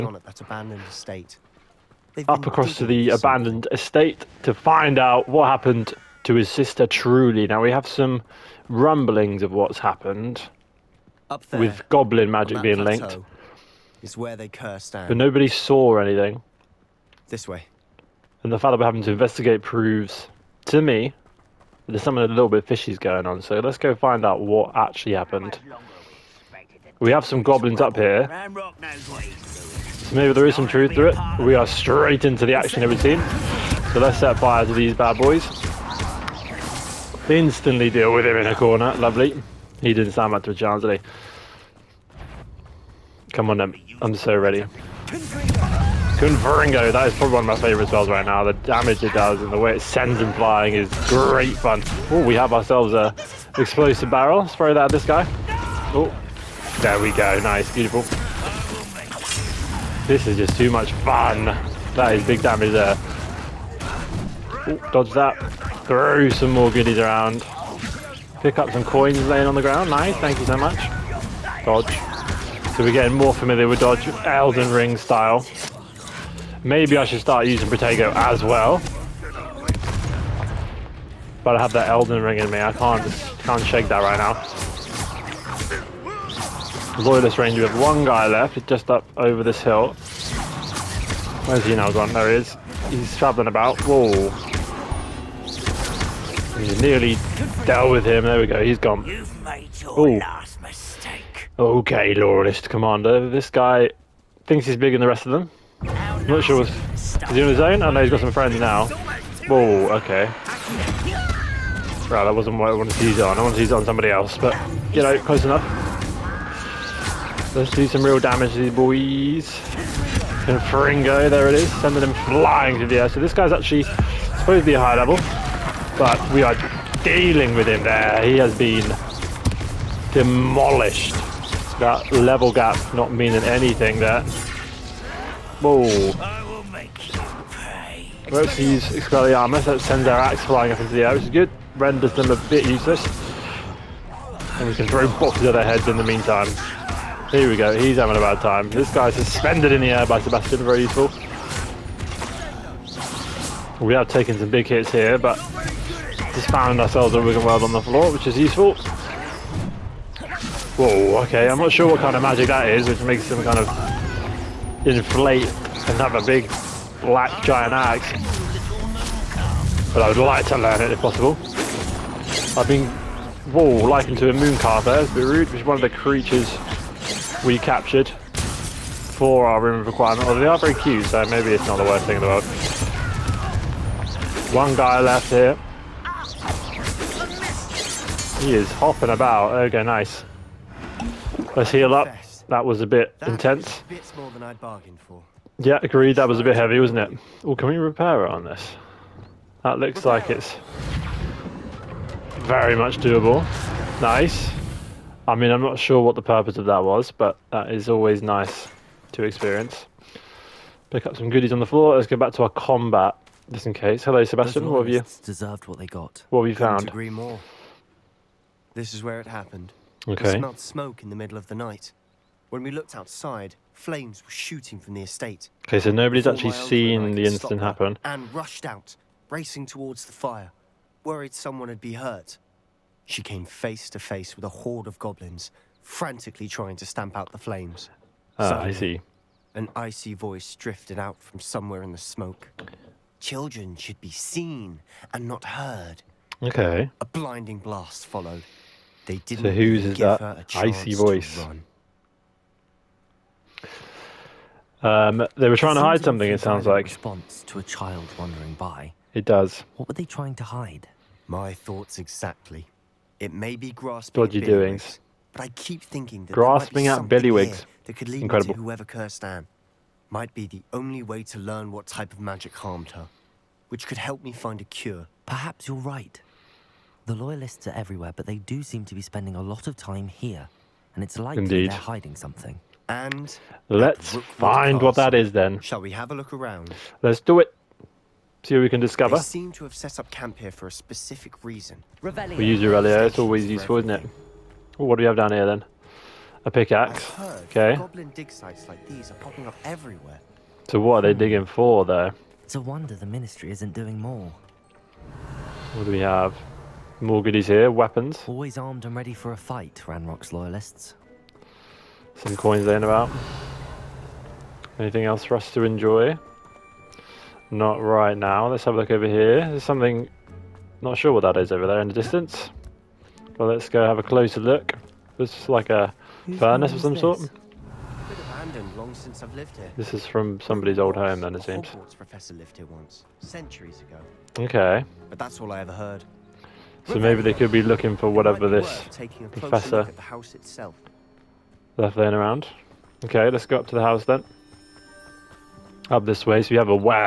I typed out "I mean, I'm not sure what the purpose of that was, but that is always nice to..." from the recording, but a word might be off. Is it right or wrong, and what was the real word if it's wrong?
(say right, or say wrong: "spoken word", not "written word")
right.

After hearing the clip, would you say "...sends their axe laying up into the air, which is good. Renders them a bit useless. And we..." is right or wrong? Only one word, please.
wrong.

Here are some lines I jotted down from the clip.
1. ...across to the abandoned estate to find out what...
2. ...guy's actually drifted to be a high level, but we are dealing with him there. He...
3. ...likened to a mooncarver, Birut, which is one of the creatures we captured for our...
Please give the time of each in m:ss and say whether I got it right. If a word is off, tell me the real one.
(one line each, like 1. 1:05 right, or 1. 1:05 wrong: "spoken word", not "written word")
1. 0:02 right
2. 2:03 wrong: "supposed", not "drifted"
3. 2:53 right.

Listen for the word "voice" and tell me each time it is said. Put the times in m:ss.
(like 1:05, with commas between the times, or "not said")
4:00, 4:10.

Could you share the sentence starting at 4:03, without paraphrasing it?
Children should be seen and not heard.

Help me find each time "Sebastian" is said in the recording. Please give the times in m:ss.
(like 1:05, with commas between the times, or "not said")
2:30, 3:34.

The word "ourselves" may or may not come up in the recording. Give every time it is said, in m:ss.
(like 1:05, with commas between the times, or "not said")
0:52, 2:36.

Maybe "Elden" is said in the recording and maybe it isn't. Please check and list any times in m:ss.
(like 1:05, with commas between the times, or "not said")
1:14, 1:21.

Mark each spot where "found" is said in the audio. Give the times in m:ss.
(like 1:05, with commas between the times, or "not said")
2:36, 3:36.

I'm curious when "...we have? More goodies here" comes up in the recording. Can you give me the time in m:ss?
5:05.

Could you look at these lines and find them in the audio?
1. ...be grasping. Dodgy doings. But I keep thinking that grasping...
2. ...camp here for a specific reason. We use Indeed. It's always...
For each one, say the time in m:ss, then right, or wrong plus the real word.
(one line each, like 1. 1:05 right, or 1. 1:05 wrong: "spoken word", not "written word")
1. 4:23 right
2. 4:50 wrong: "Revelio", not "Indeed".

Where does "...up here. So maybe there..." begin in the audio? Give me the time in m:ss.
0:27.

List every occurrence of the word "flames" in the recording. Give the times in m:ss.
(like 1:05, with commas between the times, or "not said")
3:43, 3:57.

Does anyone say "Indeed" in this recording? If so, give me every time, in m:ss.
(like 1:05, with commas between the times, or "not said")
4:41.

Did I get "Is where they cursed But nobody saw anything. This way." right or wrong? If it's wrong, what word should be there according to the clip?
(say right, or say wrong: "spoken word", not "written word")
right.